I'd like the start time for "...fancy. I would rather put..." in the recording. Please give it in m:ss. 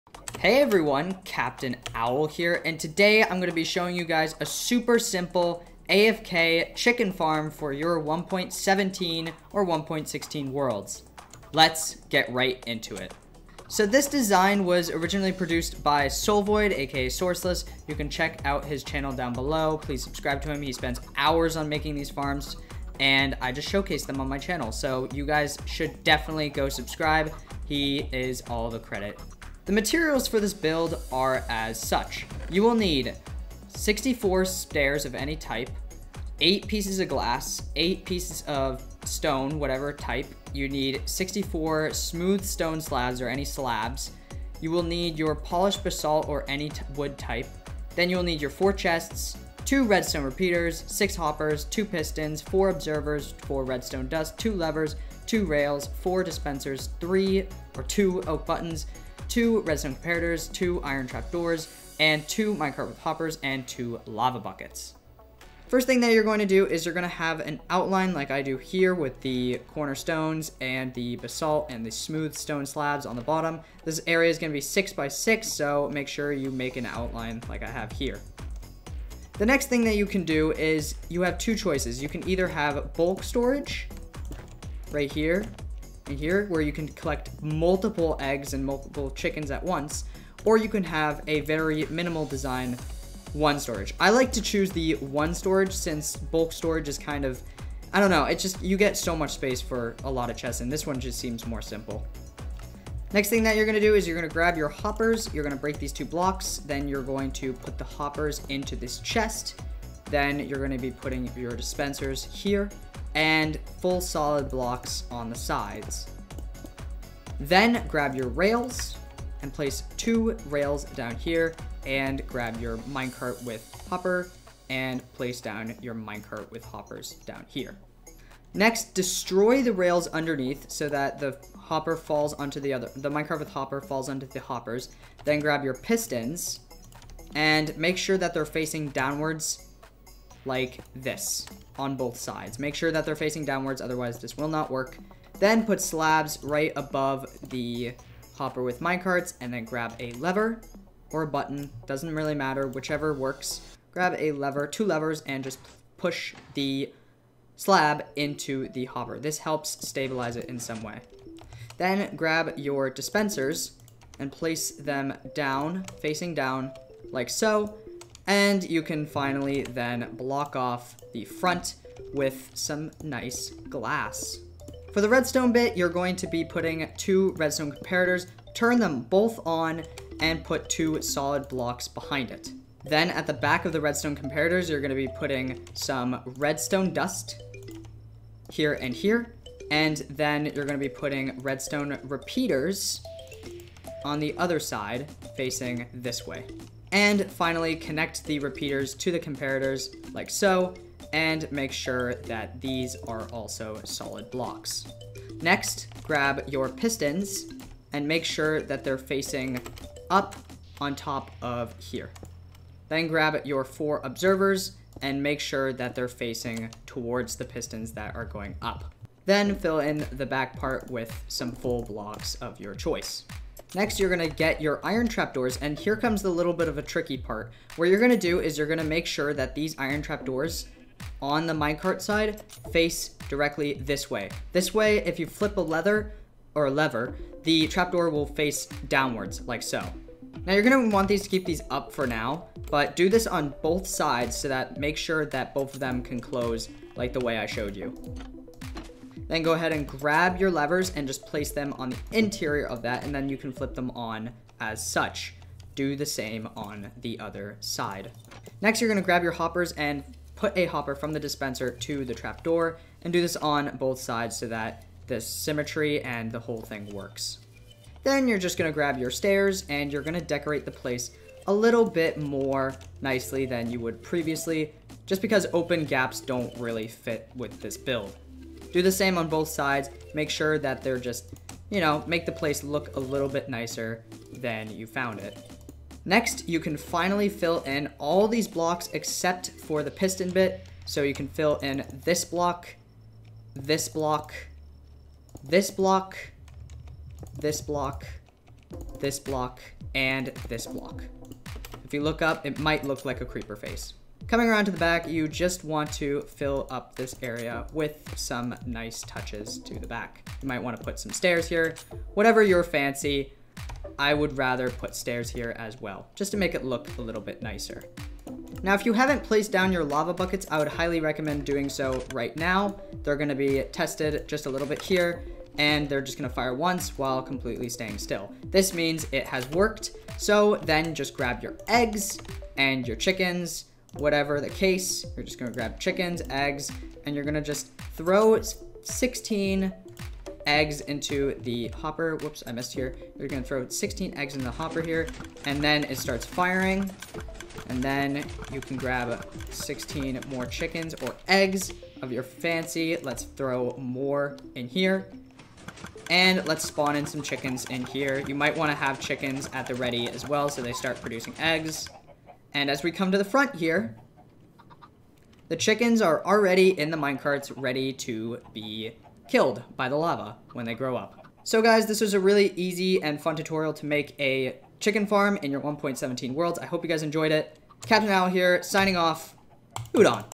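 5:12.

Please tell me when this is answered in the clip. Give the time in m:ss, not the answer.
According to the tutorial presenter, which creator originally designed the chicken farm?
0:16.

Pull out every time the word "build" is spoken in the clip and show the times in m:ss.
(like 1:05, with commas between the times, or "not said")
0:30, 4:37.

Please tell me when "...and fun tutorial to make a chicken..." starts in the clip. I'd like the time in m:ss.
6:13.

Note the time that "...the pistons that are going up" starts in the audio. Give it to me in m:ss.
3:37.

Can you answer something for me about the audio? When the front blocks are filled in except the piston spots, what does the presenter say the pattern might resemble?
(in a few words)
a creeper face.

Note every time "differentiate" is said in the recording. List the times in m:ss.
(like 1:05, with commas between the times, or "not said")
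not said.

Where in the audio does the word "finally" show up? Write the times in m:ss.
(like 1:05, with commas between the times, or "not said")
2:49, 3:17, 4:46.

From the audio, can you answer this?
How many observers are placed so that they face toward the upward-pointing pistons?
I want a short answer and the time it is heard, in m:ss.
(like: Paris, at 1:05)
4, at 3:33.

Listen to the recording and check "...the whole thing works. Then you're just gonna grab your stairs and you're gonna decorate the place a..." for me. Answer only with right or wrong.
right.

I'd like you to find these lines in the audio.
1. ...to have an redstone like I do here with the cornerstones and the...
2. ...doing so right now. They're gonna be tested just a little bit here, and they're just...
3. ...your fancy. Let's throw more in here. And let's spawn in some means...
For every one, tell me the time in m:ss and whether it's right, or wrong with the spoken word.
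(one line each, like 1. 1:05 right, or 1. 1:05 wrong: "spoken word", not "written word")
1. 1:07 wrong: "outline", not "redstone"
2. 5:21 right
3. 5:52 wrong: "chickens", not "means".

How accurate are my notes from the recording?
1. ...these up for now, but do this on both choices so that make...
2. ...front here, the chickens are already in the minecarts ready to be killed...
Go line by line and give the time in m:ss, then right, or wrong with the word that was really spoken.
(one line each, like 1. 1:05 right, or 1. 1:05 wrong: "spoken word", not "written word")
1. 4:01 wrong: "sides", not "choices"
2. 6:03 right.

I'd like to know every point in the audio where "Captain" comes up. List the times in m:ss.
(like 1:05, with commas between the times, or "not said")
0:01, 6:17.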